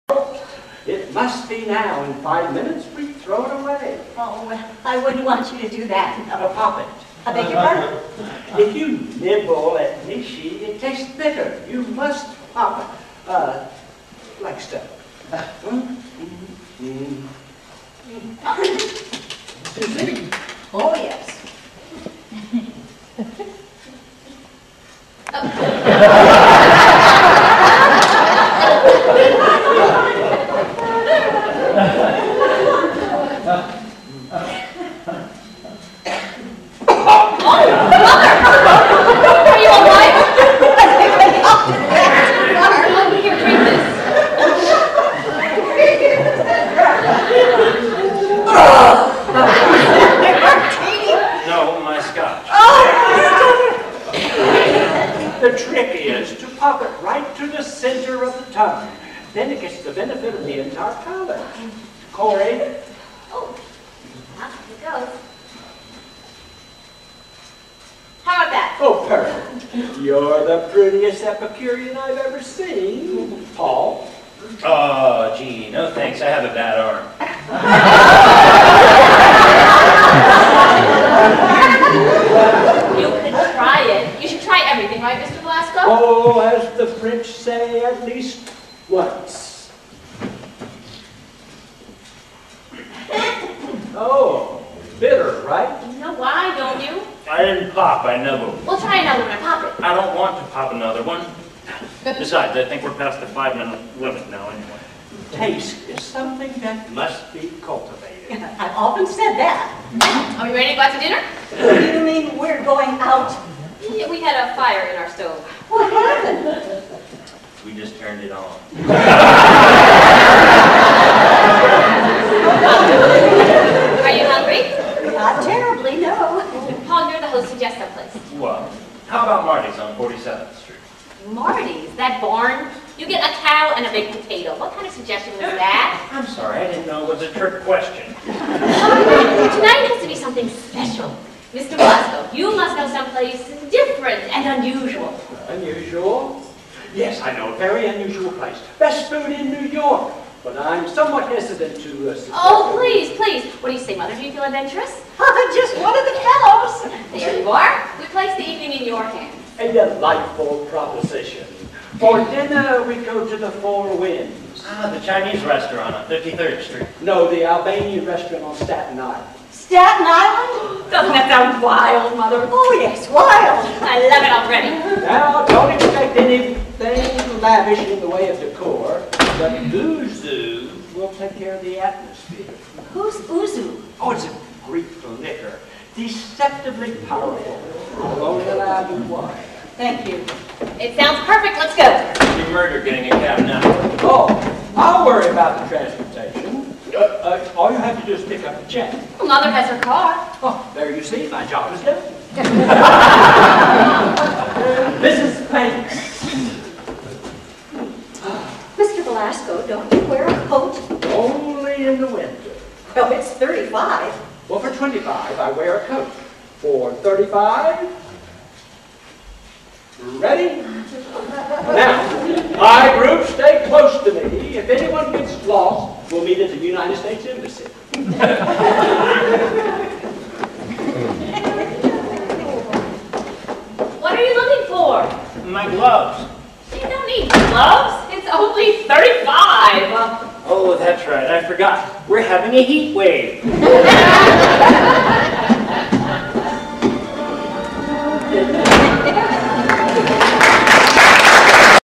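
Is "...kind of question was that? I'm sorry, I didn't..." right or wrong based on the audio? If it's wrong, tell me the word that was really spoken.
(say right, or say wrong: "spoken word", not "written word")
wrong: "suggestion", not "question".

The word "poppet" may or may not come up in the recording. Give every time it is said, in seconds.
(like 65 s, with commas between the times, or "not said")
6 s.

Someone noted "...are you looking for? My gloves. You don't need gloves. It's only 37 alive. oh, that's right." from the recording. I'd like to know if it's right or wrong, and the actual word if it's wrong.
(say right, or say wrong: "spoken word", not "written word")
wrong: "35", not "37".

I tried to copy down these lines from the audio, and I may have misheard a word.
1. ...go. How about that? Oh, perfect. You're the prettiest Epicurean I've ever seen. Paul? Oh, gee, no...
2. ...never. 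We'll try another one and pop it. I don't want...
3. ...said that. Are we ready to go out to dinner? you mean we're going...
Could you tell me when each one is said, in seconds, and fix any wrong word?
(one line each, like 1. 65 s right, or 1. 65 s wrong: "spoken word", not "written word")
1. 64 s right
2. 98 s right
3. 109 s right.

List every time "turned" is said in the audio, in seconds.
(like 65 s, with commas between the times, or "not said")
117 s.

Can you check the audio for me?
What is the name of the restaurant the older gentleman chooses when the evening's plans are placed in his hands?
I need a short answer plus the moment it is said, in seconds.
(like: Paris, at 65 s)
The Four Winds, at 163 s.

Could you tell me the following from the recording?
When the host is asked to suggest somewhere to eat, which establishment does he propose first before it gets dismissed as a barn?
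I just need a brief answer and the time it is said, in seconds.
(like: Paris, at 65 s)
Marty's on 47th Street, at 129 s.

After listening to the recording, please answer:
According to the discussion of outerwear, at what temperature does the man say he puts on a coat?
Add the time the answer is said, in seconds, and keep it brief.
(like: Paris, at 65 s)
25, at 214 s.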